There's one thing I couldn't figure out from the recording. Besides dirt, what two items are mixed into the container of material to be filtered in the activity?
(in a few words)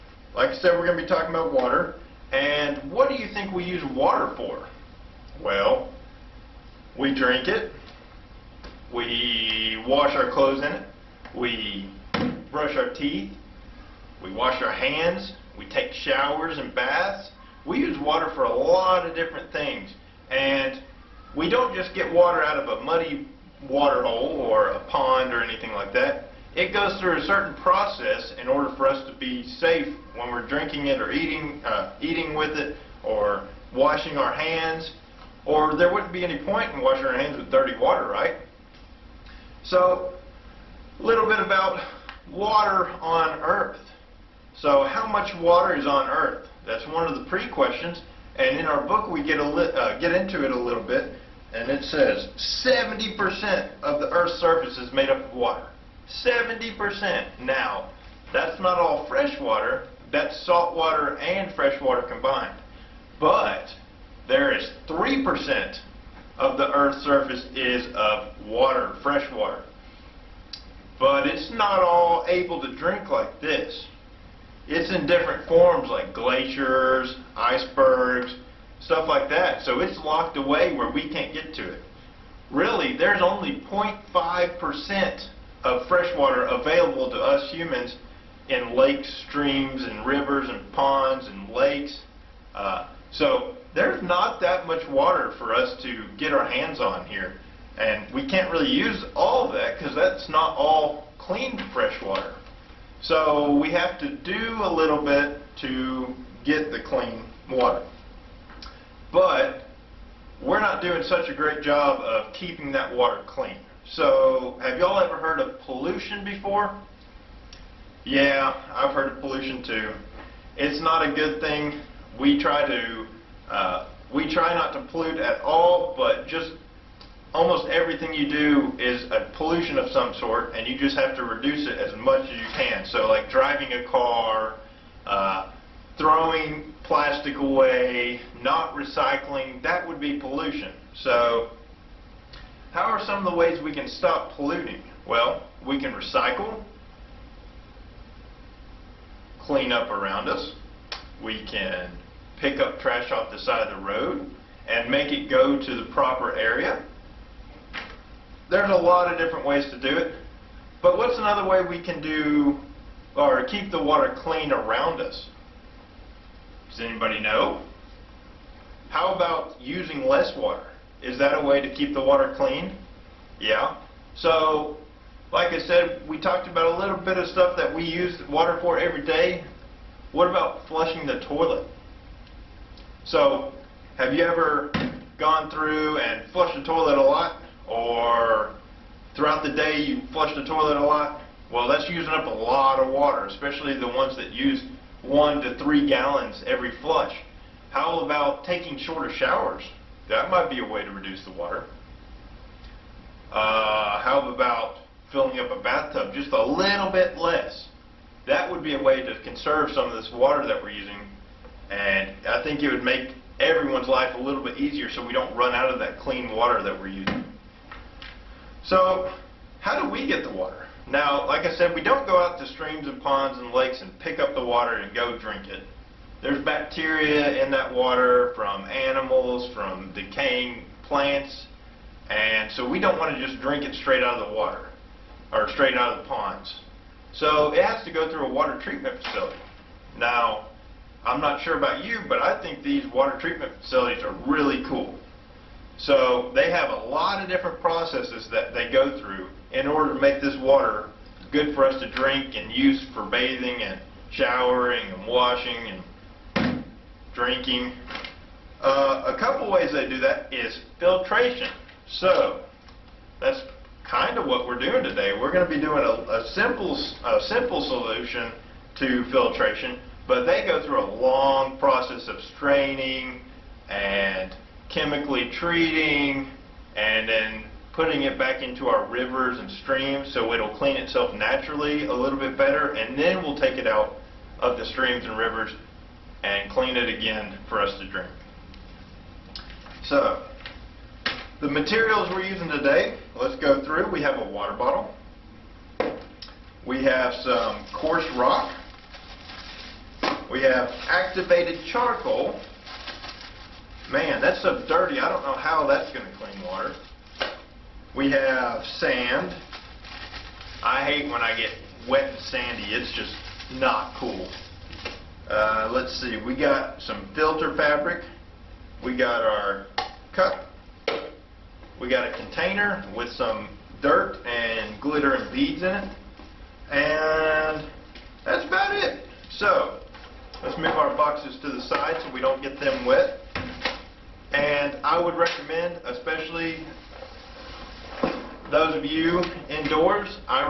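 glitter and beads.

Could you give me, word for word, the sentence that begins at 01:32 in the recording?
Uh, so there's not that much water for us to get our hands on here.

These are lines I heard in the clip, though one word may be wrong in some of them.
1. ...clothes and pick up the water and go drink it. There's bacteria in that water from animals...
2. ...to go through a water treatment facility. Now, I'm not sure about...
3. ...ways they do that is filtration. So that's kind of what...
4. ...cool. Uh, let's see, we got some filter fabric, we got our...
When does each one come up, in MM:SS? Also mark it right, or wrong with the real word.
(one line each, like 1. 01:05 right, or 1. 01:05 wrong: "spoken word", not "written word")
1. 03:43 wrong: "lakes", not "clothes"
2. 03:57 right
3. 04:19 right
4. 05:13 right.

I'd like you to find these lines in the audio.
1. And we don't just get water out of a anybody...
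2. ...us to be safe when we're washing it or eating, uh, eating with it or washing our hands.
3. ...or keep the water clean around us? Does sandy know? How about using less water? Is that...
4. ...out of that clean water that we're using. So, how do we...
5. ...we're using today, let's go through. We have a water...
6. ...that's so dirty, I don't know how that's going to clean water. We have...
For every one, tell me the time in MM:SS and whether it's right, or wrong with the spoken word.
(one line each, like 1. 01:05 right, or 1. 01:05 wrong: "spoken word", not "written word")
1. 00:20 wrong: "muddy", not "anybody"
2. 00:28 wrong: "drinking", not "washing"
3. 02:43 wrong: "anybody", not "sandy"
4. 03:35 right
5. 04:52 right
6. 05:04 right.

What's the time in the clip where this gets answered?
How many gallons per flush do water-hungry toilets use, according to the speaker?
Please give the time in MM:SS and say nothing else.
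03:15.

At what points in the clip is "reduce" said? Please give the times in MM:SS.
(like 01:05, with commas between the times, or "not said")
02:11, 03:20.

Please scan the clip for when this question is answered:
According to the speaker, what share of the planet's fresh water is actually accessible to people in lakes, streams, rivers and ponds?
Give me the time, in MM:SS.
01:23.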